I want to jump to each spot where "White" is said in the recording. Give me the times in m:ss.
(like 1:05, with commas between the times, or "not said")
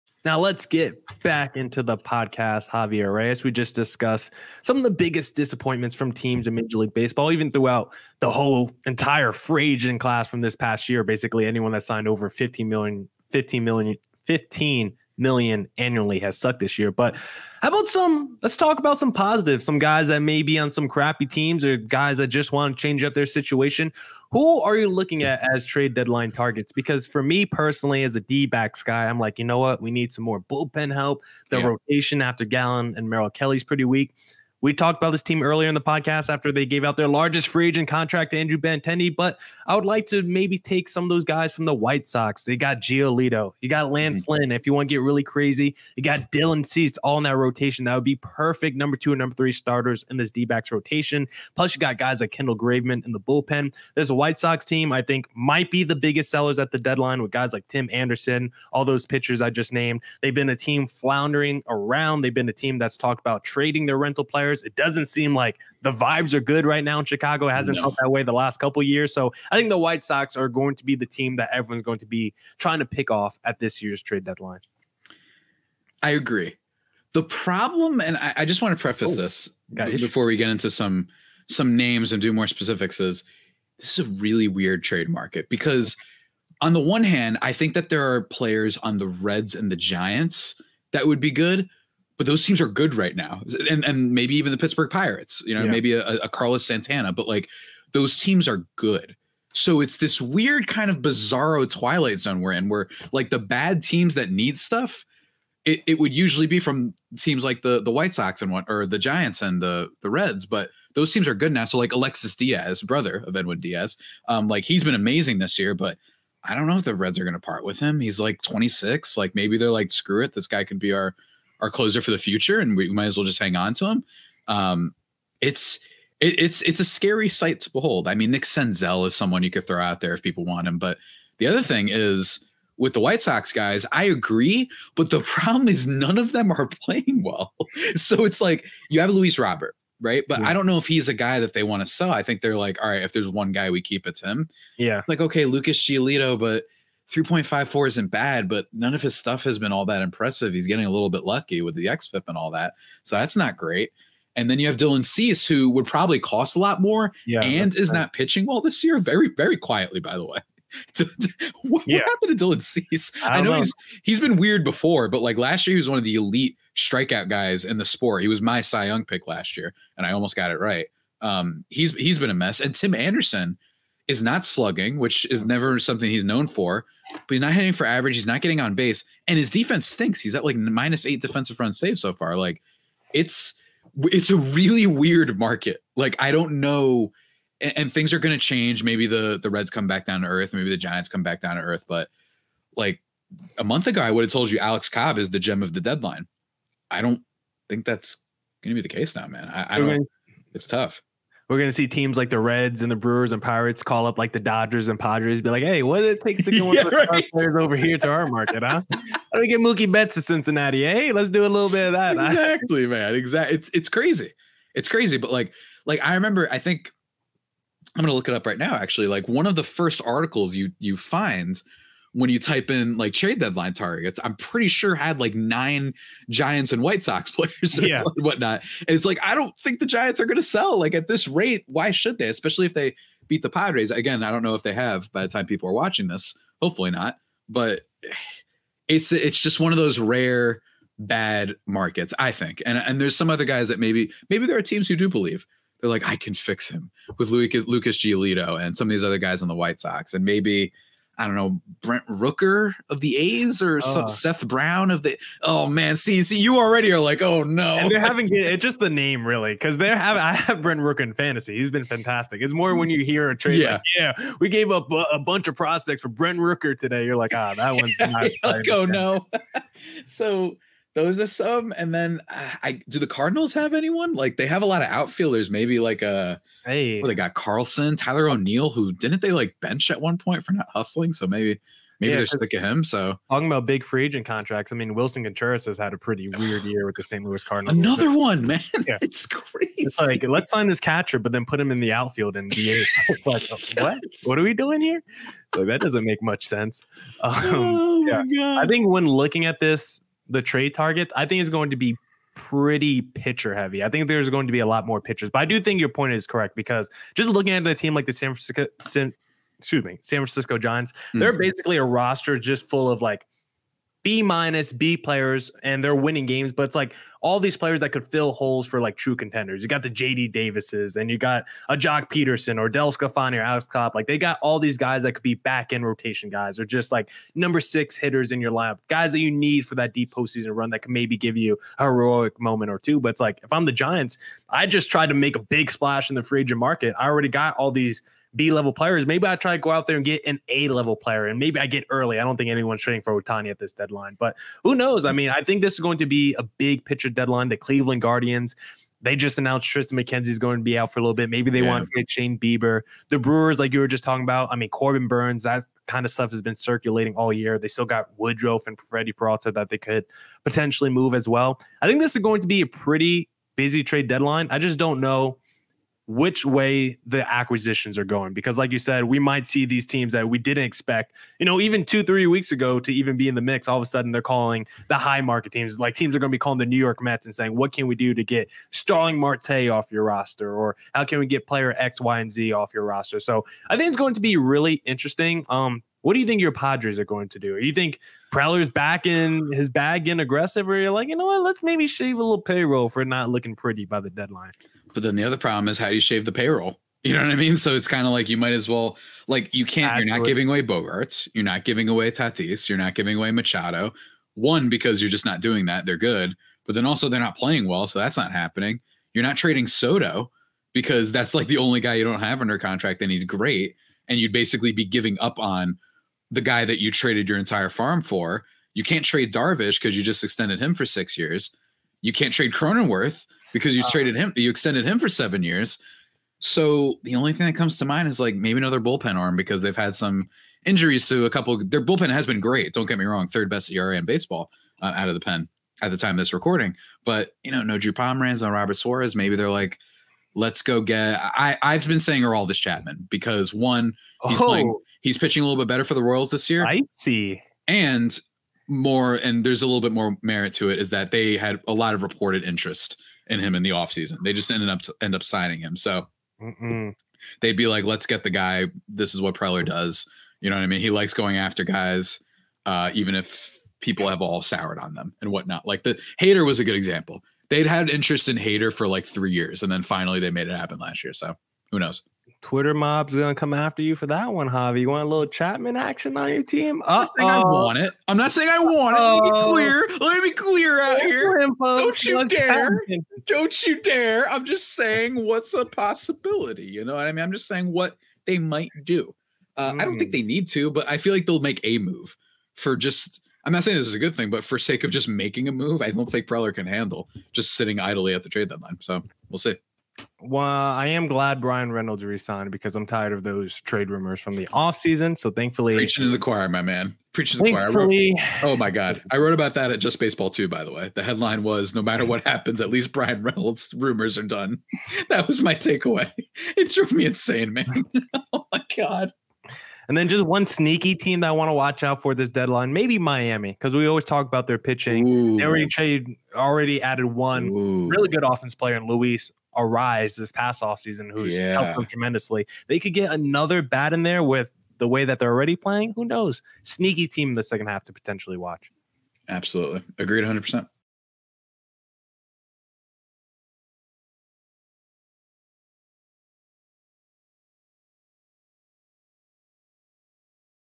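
0:41, 0:54, 1:09, 1:47, 2:12, 3:46, 4:09.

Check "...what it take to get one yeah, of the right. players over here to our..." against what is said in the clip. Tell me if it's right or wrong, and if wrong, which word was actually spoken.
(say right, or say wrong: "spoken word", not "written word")
right.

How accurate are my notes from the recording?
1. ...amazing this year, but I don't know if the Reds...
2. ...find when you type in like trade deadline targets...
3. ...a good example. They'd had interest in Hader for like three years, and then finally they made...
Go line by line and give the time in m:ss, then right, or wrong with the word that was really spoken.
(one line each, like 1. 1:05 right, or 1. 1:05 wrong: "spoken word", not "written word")
1. 1:54 right
2. 3:40 right
3. 7:46 right.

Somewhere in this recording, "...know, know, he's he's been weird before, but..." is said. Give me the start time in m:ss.
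2:43.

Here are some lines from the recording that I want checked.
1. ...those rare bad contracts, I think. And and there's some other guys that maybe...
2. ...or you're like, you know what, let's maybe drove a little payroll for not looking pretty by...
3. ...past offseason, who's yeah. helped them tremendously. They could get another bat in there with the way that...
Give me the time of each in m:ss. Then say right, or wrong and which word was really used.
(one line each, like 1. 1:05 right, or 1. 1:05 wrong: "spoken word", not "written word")
1. 3:59 wrong: "markets", not "contracts"
2. 6:30 wrong: "shave", not "drove"
3. 8:50 right.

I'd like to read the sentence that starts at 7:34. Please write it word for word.
They just ended up end up signing him.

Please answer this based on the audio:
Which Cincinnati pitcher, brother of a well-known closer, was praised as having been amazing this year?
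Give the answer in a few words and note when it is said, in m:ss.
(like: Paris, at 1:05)
Alexis Diaz, at 1:51.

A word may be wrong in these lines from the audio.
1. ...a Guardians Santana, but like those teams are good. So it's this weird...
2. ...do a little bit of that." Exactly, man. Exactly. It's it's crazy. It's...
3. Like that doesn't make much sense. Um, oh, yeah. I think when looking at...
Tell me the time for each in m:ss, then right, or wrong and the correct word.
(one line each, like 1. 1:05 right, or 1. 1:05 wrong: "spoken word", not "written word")
1. 1:36 wrong: "Carlos", not "Guardians"
2. 3:31 right
3. 4:55 right.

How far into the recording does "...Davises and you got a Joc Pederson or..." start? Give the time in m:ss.
5:20.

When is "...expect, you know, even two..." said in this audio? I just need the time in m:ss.
6:10.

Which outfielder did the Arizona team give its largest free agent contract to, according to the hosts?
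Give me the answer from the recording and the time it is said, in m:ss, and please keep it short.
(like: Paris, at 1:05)
Andrew Benintendi, at 0:38.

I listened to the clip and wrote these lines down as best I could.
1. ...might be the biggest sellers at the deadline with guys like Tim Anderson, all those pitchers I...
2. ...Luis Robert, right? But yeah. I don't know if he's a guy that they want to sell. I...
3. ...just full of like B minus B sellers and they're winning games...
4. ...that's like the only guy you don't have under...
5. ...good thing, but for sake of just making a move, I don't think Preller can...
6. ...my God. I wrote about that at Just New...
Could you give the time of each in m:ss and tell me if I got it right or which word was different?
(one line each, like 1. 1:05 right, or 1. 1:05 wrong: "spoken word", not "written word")
1. 0:55 right
2. 2:19 right
3. 5:12 wrong: "players", not "sellers"
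4. 6:51 right
5. 8:13 right
6. 8:28 wrong: "Baseball", not "New".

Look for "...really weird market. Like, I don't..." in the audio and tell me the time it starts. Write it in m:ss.
3:04.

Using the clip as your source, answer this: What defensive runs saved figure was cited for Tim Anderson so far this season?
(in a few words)
minus eight.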